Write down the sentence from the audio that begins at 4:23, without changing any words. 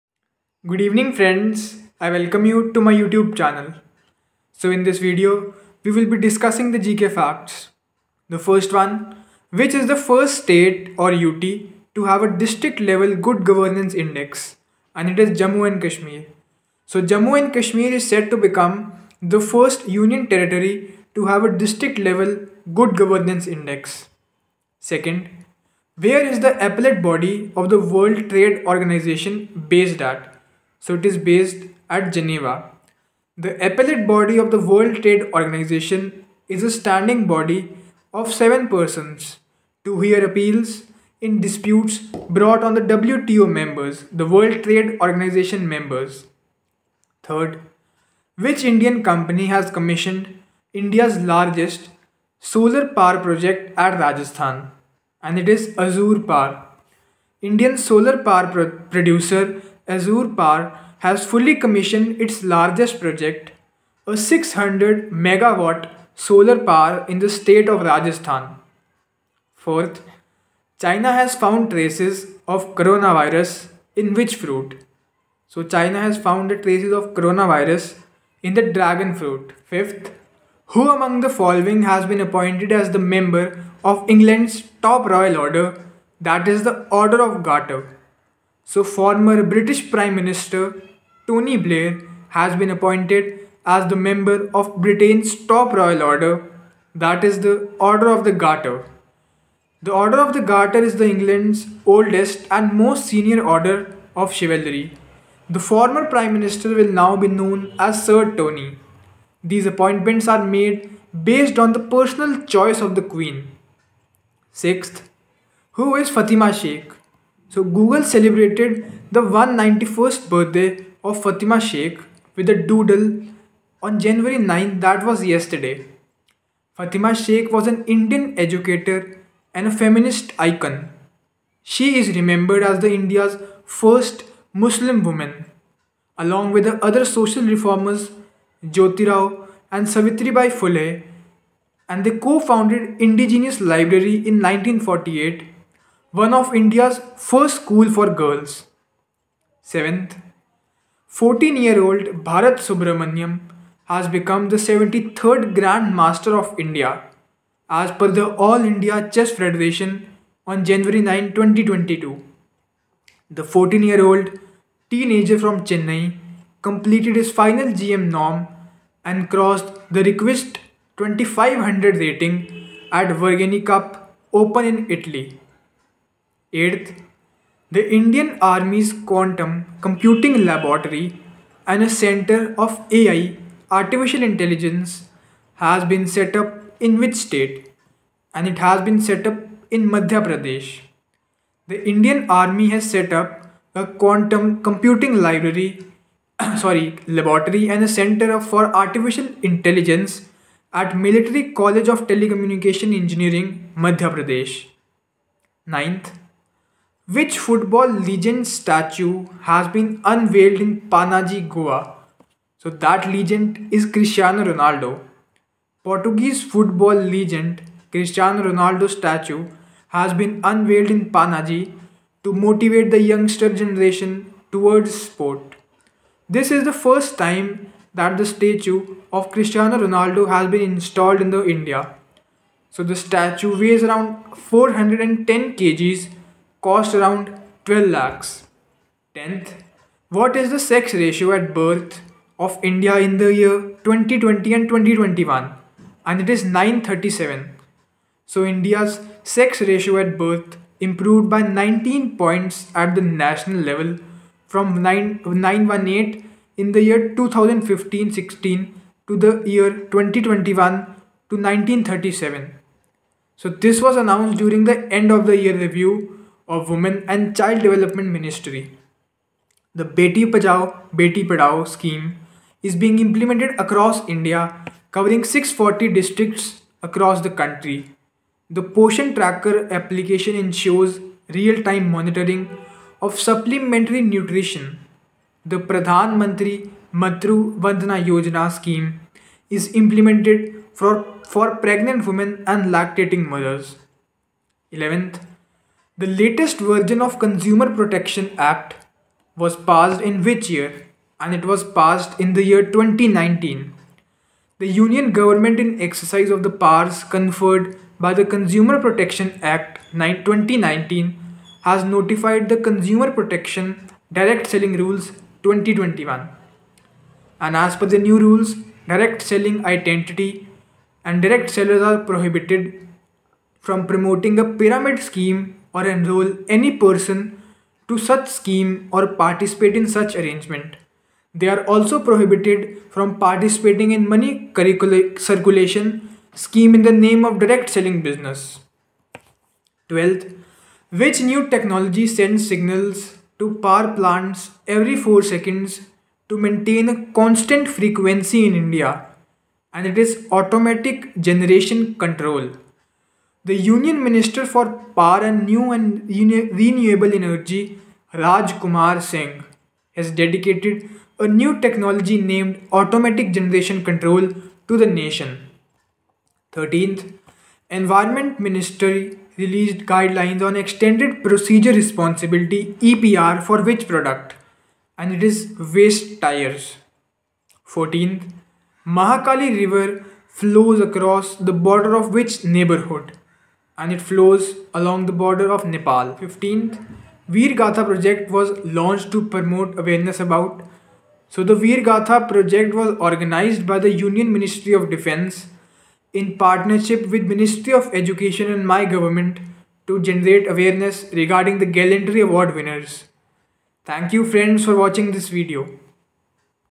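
So this was announced during the end of the year review of Women and Child Development Ministry.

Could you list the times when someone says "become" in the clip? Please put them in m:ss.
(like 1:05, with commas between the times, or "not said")
0:18, 2:34.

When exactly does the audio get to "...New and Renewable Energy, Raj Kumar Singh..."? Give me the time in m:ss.
5:55.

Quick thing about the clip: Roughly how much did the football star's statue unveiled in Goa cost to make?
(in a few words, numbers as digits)
12 lakhs.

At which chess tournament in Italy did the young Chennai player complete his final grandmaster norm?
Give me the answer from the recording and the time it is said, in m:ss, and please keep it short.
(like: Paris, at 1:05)
Vergani Cup Open, at 2:53.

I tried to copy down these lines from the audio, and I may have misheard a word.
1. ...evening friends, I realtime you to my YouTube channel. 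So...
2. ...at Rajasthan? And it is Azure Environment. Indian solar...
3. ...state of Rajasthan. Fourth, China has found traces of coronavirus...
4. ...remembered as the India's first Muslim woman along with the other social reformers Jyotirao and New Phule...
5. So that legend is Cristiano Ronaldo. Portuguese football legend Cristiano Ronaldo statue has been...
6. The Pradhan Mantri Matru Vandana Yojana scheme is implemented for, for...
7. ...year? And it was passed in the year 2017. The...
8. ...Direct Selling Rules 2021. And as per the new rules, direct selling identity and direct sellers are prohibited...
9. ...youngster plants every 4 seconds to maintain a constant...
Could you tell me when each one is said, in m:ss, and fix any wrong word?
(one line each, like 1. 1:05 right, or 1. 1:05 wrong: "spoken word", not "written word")
1. 0:00 wrong: "welcome", not "realtime"
2. 0:53 wrong: "Power", not "Environment"
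3. 1:07 right
4. 2:12 wrong: "Savitribai", not "New"
5. 3:32 right
6. 4:45 right
7. 5:00 wrong: "2019", not "2017"
8. 5:14 right
9. 5:43 wrong: "power", not "youngster".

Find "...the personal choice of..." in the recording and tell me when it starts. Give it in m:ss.
1:51.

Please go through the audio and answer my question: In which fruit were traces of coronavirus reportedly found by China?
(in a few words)
Dragon fruit.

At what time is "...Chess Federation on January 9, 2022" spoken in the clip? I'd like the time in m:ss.
2:39.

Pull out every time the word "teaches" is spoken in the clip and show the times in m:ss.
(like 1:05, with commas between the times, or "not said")
not said.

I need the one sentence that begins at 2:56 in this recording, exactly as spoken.
Eighth, the Indian Army's Quantum Computing Laboratory and a center of AI, Artificial Intelligence, has been set up in which state?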